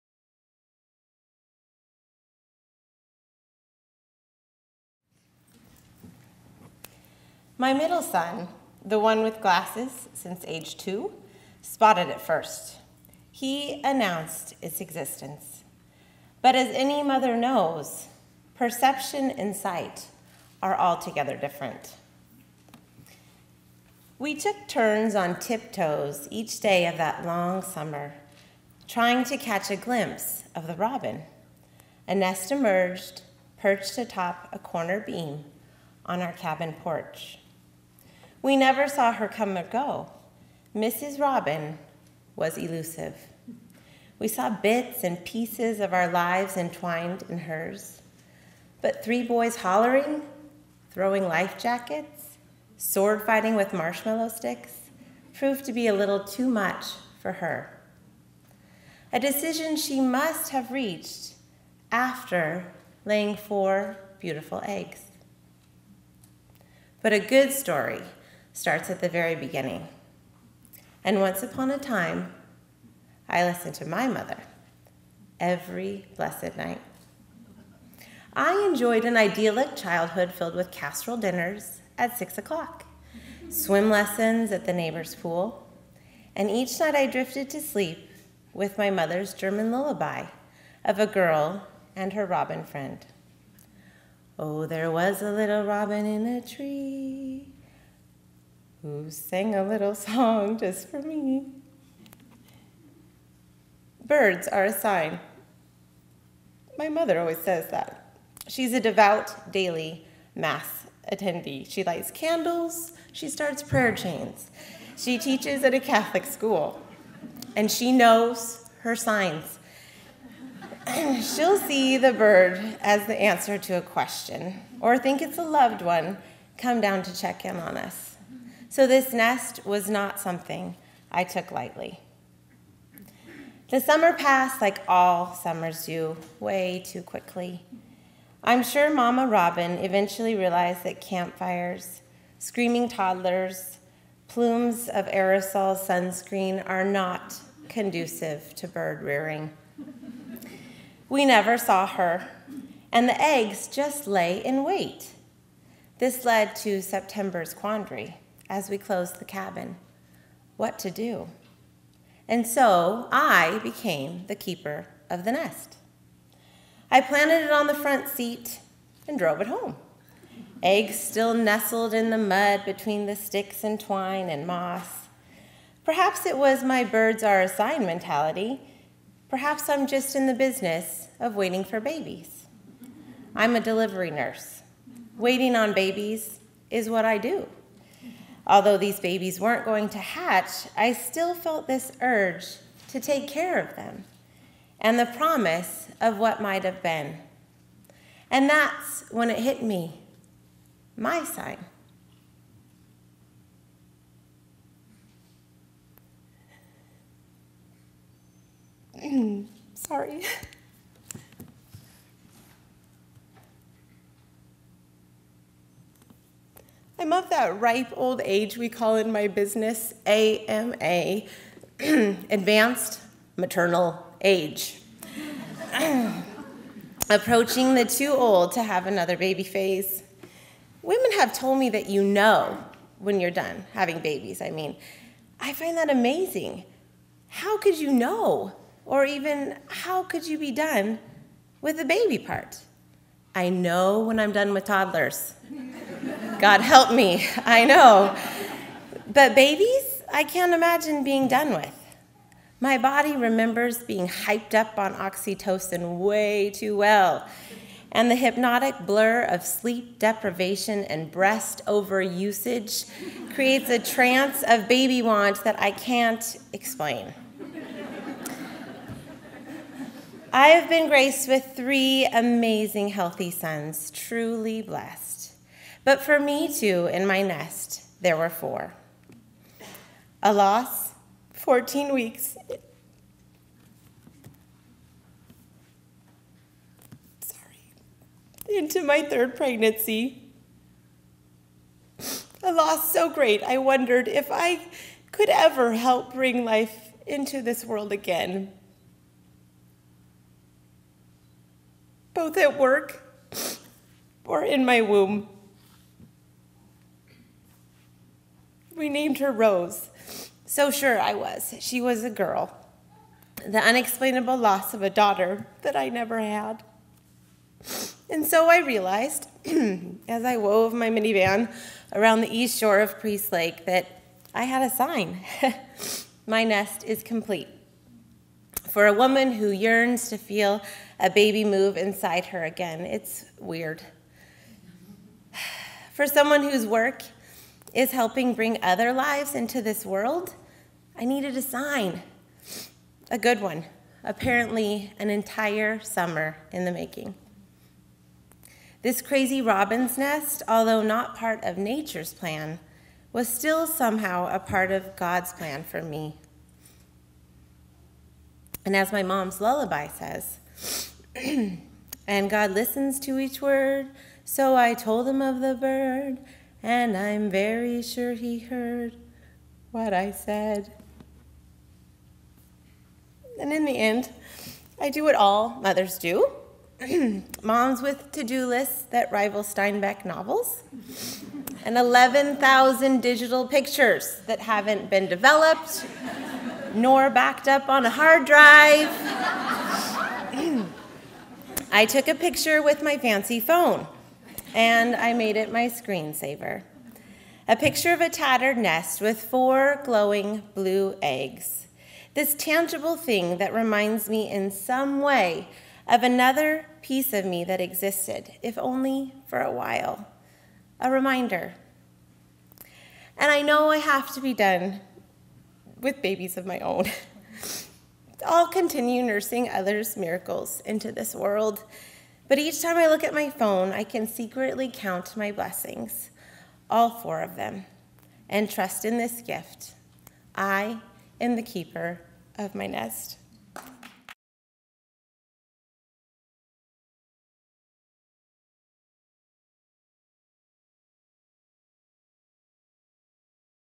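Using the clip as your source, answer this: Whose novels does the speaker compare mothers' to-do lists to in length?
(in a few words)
Steinbeck.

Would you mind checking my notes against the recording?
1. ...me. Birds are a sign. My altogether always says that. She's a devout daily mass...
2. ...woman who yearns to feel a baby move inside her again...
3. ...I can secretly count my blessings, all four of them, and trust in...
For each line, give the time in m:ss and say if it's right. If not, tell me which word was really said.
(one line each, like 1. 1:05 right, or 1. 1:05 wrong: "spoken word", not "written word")
1. 1:41 wrong: "mother", not "altogether"
2. 5:28 right
3. 7:03 right.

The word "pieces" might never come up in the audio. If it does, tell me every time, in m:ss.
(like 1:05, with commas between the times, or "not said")
0:45, 6:46.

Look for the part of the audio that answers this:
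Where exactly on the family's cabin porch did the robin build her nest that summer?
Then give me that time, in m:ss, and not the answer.
0:34.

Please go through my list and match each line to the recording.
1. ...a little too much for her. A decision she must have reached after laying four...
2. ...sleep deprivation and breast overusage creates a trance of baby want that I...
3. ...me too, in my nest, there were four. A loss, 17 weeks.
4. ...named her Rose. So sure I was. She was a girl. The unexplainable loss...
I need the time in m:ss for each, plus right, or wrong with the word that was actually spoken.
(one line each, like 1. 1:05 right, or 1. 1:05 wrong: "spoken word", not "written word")
1. 0:55 right
2. 4:19 right
3. 4:36 wrong: "14", not "17"
4. 5:08 right.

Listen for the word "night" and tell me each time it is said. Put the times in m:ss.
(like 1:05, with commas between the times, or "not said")
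1:16, 1:26.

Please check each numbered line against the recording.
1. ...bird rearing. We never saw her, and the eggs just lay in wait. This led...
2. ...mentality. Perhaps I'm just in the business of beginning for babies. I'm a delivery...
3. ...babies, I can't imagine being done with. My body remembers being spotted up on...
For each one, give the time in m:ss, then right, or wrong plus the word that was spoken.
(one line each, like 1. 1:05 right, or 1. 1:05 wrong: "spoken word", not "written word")
1. 2:28 right
2. 2:57 wrong: "waiting", not "beginning"
3. 4:09 wrong: "hyped", not "spotted".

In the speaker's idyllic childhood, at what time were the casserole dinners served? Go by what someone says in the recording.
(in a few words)
6 o'clock.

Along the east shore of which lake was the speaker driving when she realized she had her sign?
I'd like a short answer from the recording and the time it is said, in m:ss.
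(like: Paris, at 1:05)
Priest Lake, at 5:22.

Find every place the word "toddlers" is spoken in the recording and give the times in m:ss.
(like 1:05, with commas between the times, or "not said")
2:22, 4:04.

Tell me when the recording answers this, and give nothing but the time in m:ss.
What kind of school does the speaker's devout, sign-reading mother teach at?
1:55.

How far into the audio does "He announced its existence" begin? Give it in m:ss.
0:13.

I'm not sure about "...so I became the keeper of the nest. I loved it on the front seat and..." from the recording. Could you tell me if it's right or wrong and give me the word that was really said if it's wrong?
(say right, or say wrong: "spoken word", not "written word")
wrong: "planted", not "loved".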